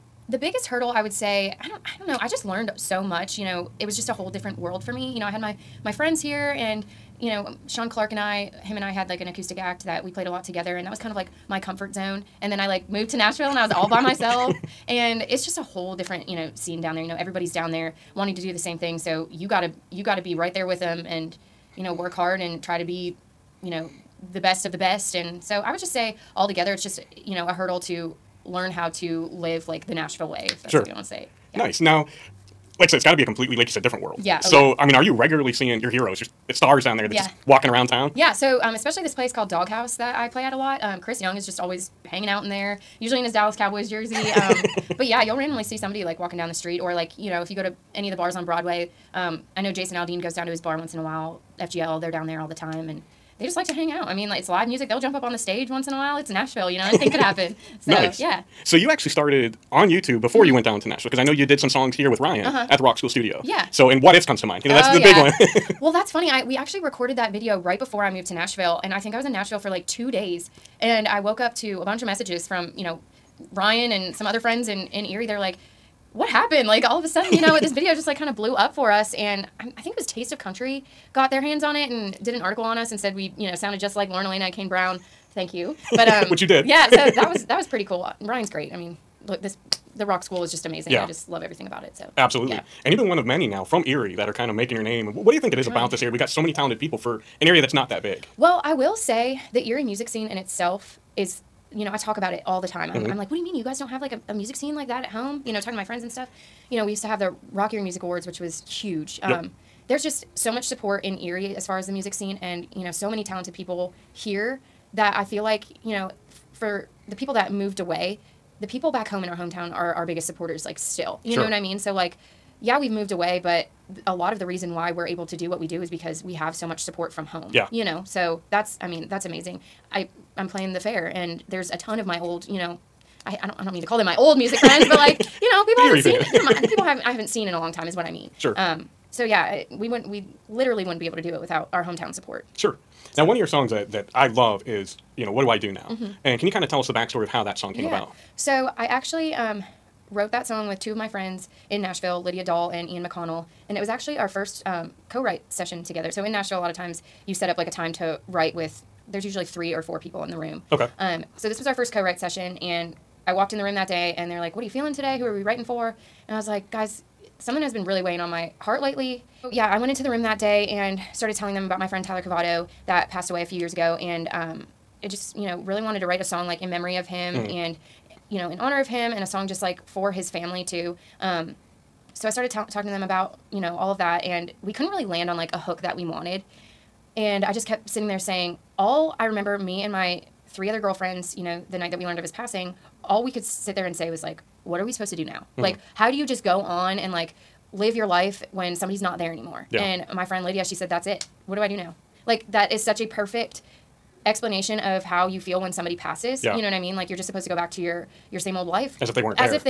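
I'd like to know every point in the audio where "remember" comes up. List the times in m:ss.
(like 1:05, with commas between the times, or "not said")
3:09.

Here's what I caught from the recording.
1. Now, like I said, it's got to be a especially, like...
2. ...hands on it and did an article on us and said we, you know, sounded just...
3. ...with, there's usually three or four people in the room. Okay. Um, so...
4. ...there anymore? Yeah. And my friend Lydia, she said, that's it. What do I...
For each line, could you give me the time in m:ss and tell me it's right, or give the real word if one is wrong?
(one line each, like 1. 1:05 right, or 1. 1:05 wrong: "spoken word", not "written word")
1. 0:31 wrong: "completely", not "especially"
2. 1:21 right
3. 2:38 right
4. 3:19 right.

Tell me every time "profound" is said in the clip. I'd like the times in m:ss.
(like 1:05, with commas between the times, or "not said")
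not said.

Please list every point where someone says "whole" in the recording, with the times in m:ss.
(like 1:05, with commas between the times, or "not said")
0:04, 0:15.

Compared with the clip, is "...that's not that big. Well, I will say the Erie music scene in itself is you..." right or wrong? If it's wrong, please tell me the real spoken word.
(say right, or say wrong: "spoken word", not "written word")
right.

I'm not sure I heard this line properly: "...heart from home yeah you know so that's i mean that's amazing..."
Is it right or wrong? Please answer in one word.
wrong.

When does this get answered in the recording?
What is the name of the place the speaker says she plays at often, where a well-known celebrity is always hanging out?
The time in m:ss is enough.
0:39.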